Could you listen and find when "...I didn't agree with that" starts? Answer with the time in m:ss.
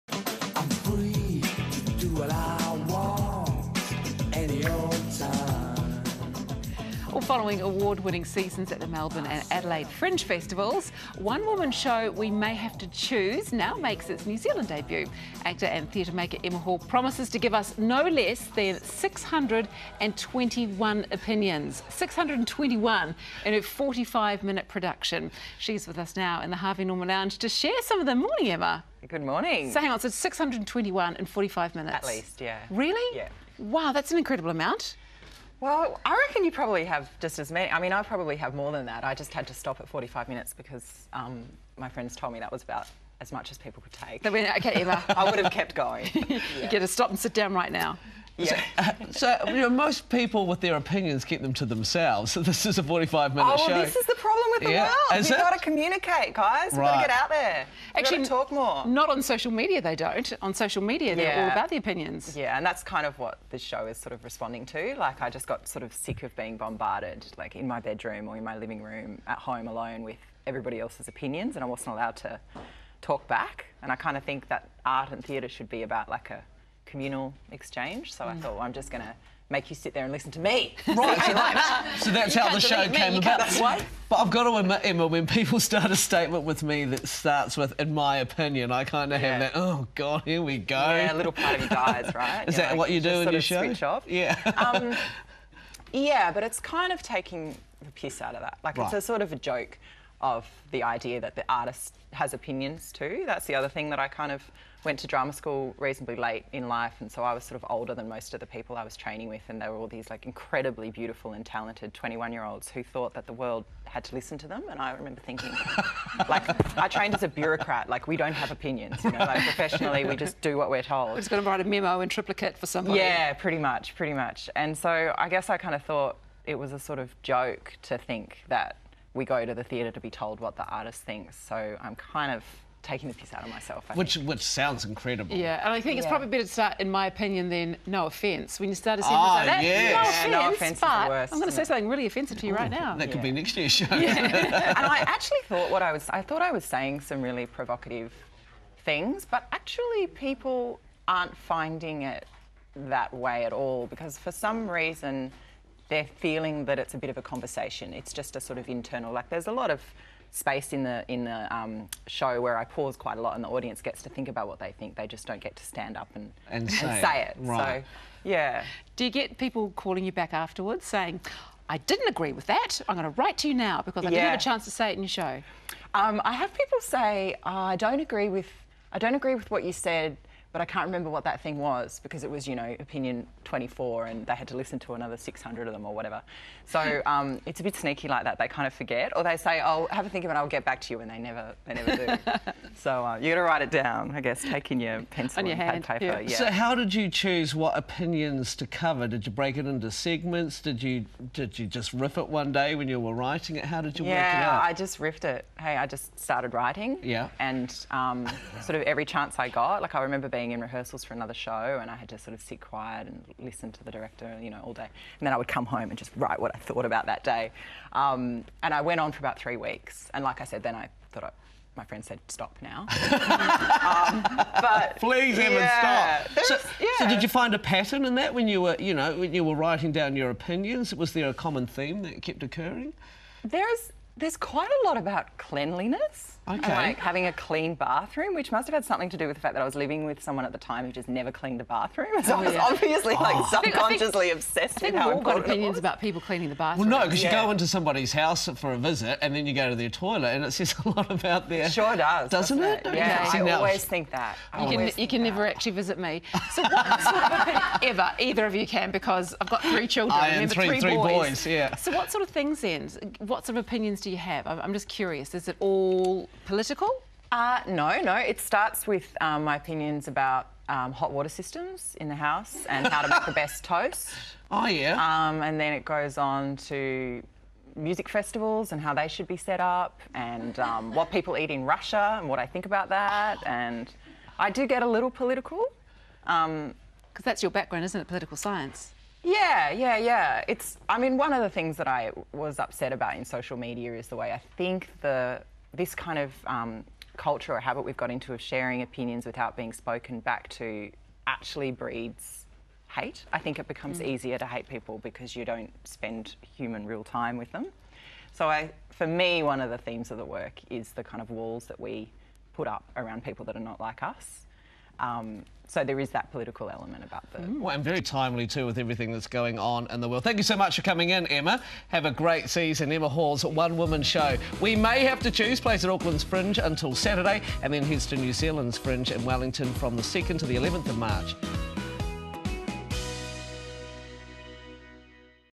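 2:51.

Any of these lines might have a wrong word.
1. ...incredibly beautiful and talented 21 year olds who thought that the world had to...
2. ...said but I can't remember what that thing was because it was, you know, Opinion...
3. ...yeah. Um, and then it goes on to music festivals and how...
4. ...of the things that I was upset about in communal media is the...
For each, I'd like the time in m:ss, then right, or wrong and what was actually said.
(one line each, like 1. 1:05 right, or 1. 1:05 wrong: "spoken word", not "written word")
1. 1:50 right
2. 2:59 right
3. 4:34 right
4. 4:51 wrong: "social", not "communal".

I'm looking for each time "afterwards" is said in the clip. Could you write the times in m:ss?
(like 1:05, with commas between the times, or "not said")
2:50.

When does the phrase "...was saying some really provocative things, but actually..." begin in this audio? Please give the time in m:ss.
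2:26.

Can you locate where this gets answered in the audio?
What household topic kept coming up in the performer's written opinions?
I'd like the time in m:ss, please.
3:55.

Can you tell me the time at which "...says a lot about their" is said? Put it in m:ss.
4:10.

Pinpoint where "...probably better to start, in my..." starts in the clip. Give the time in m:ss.
2:16.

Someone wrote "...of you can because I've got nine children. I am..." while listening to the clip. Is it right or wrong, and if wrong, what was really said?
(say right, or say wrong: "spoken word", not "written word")
wrong: "three", not "nine".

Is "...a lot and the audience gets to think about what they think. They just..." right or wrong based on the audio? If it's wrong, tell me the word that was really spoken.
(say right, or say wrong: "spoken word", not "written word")
right.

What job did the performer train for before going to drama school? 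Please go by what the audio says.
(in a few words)
bureaucrat.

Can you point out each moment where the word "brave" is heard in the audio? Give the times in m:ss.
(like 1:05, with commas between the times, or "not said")
not said.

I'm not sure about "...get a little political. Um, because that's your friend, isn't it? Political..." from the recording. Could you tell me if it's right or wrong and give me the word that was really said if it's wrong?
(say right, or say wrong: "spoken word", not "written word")
wrong: "background", not "friend".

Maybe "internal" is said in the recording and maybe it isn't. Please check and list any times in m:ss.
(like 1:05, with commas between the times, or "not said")
2:38.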